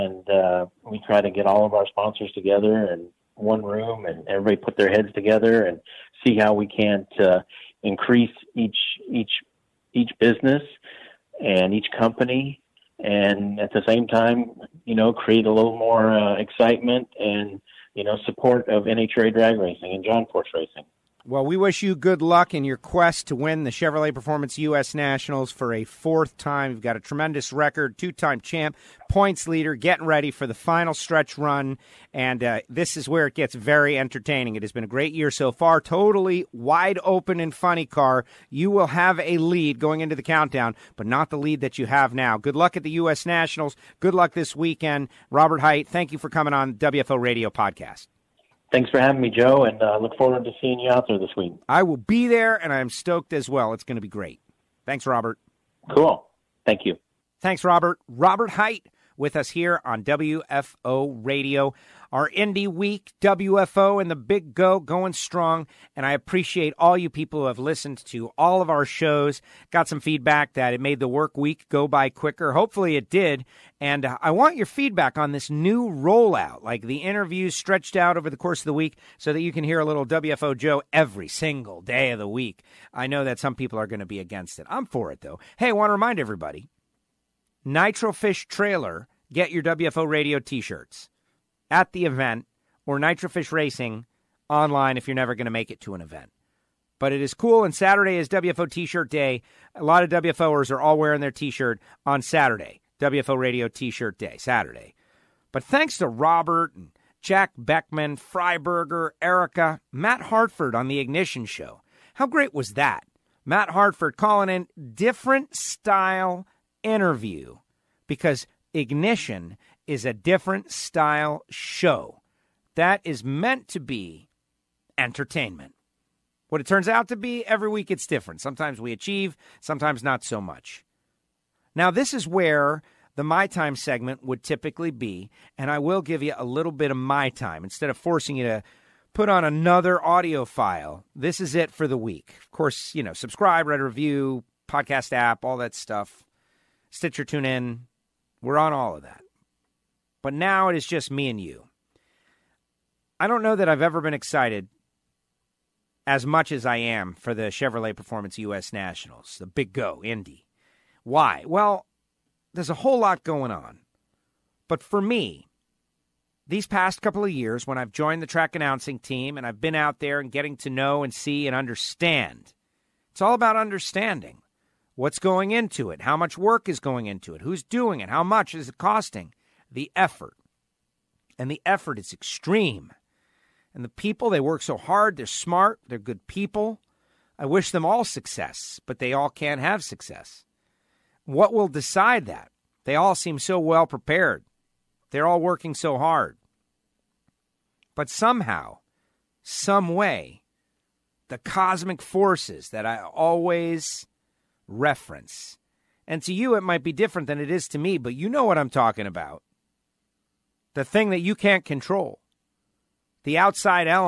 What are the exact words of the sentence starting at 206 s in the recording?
And to you, it might be different than it is to me, but you know what I'm talking about.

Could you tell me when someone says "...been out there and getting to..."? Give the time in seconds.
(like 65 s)
169 s.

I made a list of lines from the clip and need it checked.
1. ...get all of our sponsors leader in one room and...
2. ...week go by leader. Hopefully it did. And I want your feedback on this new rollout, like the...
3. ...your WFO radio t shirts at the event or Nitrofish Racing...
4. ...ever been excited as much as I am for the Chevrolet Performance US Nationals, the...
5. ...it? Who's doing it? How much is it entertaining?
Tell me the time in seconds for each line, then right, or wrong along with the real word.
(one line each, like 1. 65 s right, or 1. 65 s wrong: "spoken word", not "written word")
1. 1 s wrong: "together", not "leader"
2. 71 s wrong: "quicker", not "leader"
3. 89 s right
4. 153 s right
5. 177 s wrong: "costing", not "entertaining".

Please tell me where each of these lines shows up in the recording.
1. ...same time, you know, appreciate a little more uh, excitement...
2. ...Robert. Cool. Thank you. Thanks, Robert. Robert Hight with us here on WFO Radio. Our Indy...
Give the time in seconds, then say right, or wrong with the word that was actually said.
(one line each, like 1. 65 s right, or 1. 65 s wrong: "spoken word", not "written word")
1. 13 s wrong: "create", not "appreciate"
2. 55 s right.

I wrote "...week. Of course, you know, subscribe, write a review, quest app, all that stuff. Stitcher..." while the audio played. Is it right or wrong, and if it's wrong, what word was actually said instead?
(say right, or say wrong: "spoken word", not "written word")
wrong: "podcast", not "quest".